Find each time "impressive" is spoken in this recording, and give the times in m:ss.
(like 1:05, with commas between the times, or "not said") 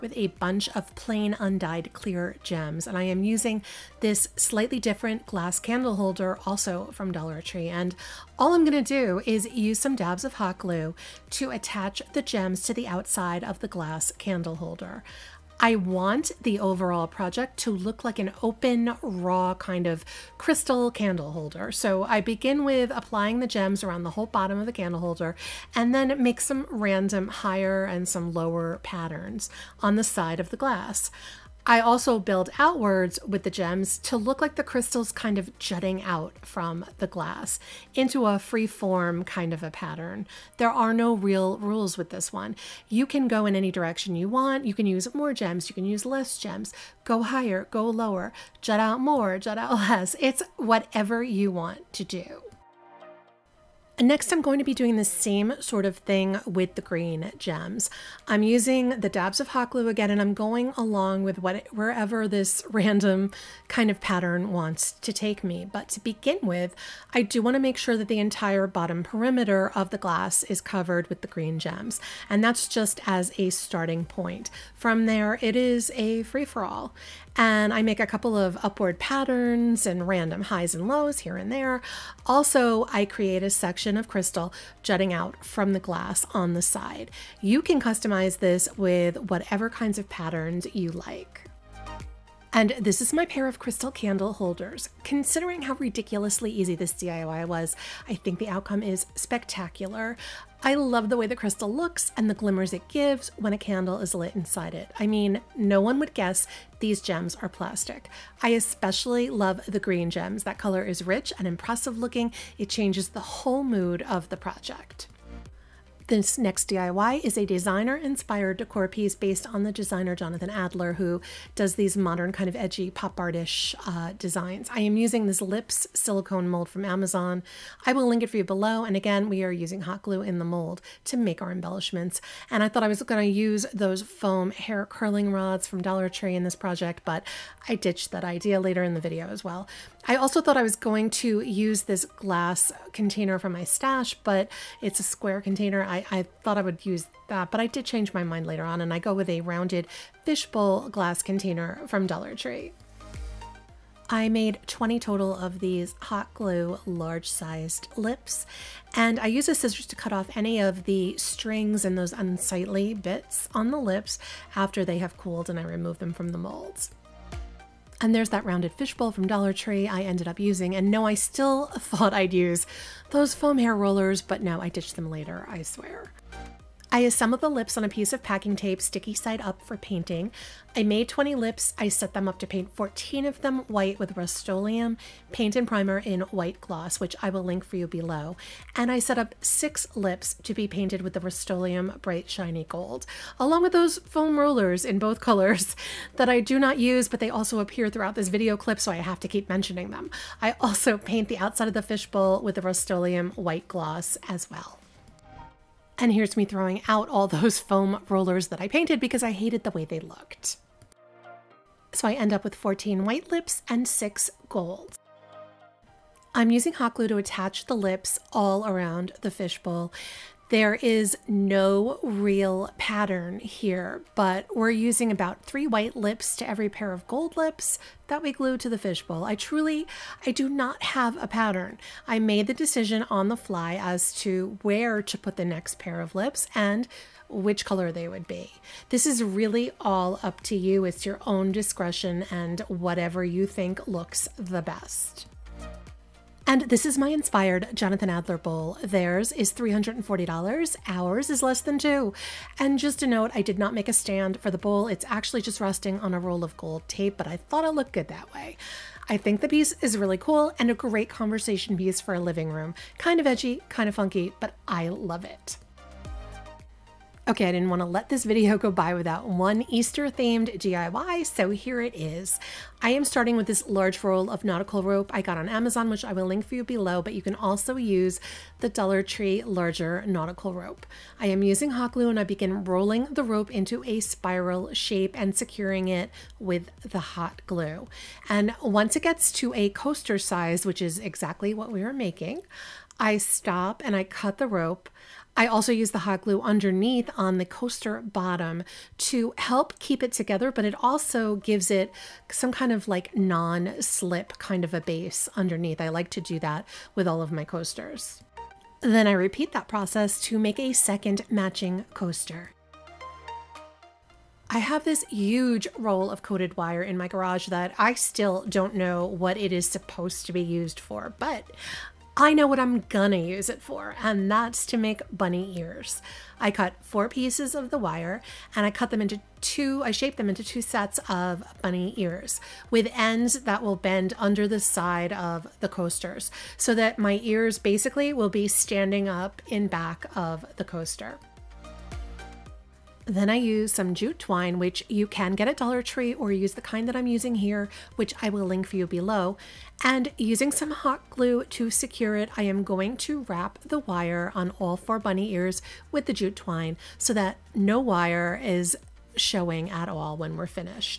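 1:51.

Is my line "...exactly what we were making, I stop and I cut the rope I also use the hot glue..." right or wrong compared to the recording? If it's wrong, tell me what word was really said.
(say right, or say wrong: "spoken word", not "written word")
right.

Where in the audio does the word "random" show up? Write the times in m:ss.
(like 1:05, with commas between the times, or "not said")
0:26, 1:02, 1:20.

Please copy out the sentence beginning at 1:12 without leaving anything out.
And that's just as a starting point.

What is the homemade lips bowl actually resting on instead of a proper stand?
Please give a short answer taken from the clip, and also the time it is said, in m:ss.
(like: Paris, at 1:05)
A roll of gold tape, at 4:16.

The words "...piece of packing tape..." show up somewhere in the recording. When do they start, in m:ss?
2:57.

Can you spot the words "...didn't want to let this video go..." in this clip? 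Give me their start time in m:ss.
4:27.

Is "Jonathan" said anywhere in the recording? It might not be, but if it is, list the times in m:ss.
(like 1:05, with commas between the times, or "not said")
2:00, 4:07.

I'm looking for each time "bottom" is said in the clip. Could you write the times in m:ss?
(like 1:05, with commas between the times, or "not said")
0:24, 1:08, 4:58.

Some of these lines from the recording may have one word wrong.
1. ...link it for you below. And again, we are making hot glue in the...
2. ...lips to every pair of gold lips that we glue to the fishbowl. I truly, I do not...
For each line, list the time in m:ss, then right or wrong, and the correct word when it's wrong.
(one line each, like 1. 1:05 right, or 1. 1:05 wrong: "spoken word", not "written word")
1. 2:08 wrong: "using", not "making"
2. 3:45 right.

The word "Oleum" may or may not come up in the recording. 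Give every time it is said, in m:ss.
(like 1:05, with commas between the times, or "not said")
3:04, 3:11, 3:22.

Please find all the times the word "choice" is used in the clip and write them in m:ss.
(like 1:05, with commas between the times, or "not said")
not said.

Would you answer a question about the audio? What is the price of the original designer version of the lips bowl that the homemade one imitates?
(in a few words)
$340.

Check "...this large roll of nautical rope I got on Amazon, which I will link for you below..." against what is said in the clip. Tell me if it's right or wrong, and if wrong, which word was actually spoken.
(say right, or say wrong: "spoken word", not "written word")
right.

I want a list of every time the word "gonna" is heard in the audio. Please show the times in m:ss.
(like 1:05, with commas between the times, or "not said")
0:08, 5:22.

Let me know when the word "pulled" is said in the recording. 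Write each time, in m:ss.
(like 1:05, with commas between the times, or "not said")
not said.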